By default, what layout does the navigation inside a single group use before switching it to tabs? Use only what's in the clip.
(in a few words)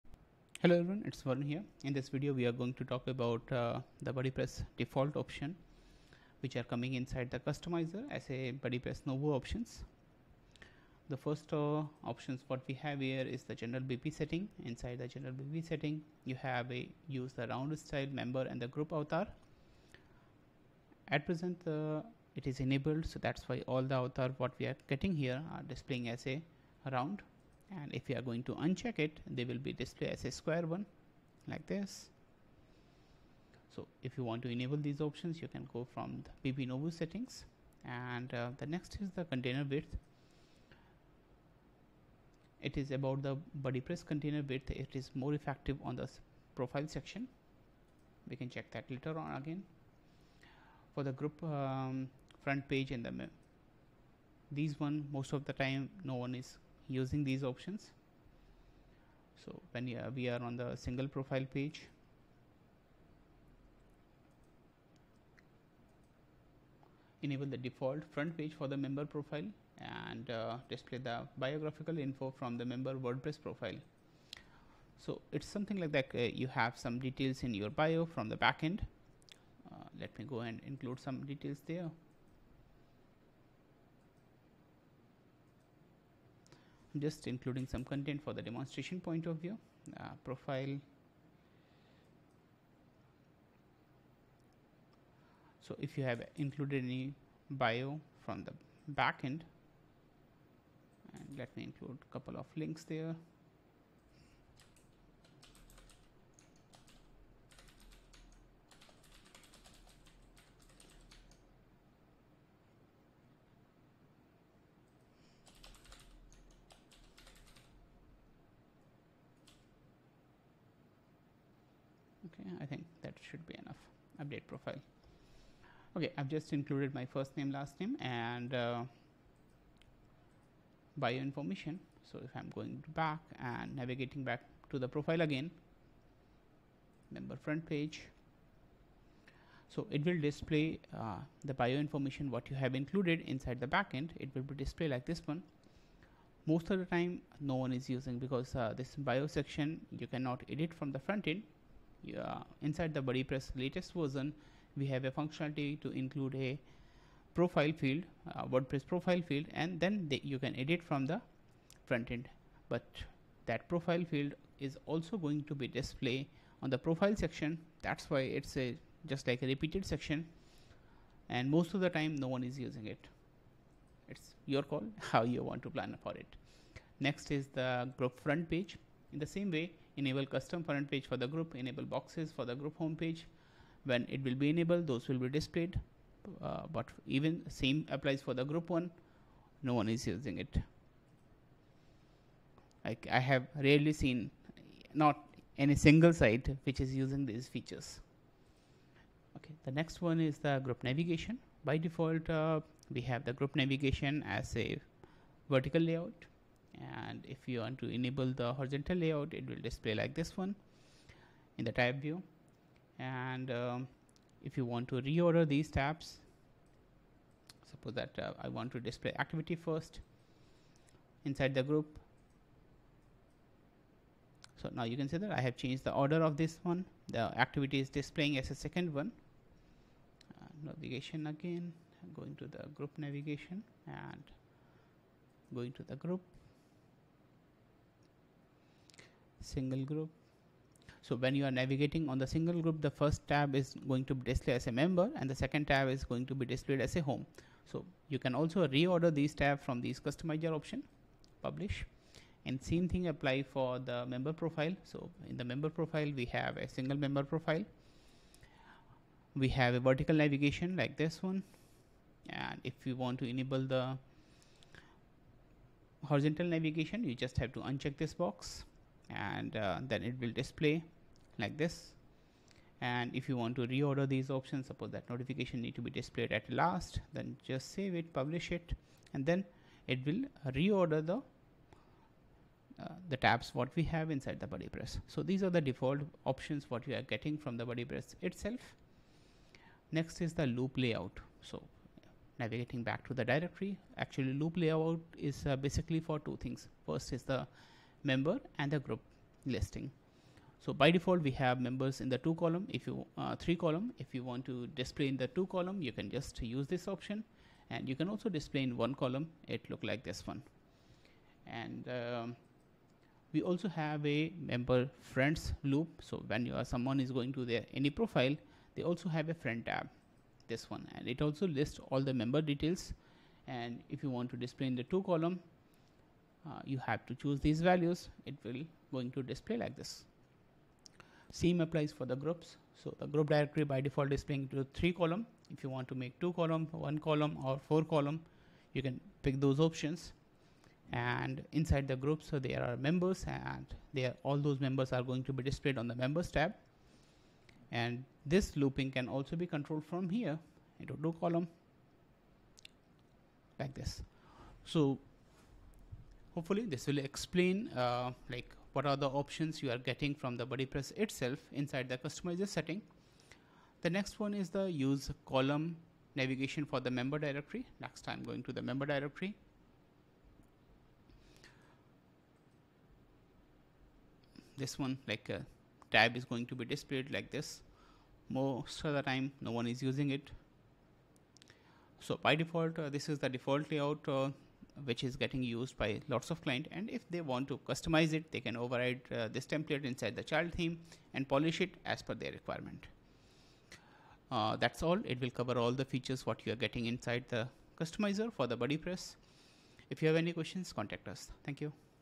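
vertical layout.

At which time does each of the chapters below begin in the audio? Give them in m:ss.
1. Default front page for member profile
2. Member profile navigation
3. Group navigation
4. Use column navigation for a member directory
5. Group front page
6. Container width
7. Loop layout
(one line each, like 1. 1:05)
1. 1:07
2. 4:15
3. 3:22
4. 6:06
5. 2:19
6. 0:40
7. 4:50.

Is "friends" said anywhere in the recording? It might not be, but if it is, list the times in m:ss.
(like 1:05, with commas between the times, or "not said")
5:14, 5:19.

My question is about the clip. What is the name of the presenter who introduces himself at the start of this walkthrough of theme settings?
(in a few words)
Varun.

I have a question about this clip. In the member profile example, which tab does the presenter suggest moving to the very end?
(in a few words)
notification.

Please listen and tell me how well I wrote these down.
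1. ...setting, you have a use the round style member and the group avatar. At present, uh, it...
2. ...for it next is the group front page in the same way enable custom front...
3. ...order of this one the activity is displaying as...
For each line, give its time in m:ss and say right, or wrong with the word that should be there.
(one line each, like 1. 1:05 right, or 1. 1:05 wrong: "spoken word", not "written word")
1. 0:15 right
2. 2:56 right
3. 3:45 right.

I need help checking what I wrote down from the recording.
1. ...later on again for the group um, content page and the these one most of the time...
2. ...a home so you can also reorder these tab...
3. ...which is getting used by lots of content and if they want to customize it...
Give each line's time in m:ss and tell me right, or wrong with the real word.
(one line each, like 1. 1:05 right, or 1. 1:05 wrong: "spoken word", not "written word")
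1. 0:48 wrong: "front", not "content"
2. 4:06 right
3. 6:24 wrong: "client", not "content".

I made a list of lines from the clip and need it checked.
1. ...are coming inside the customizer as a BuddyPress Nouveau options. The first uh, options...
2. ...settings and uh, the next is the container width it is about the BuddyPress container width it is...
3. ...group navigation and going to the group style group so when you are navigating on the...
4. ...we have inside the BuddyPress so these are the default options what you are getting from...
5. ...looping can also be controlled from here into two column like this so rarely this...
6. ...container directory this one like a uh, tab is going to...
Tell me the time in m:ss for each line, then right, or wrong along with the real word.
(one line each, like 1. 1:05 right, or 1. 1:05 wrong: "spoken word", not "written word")
1. 0:06 right
2. 0:36 right
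3. 3:52 wrong: "single", not "style"
4. 4:43 right
5. 5:48 wrong: "hopefully", not "rarely"
6. 6:08 wrong: "member", not "container".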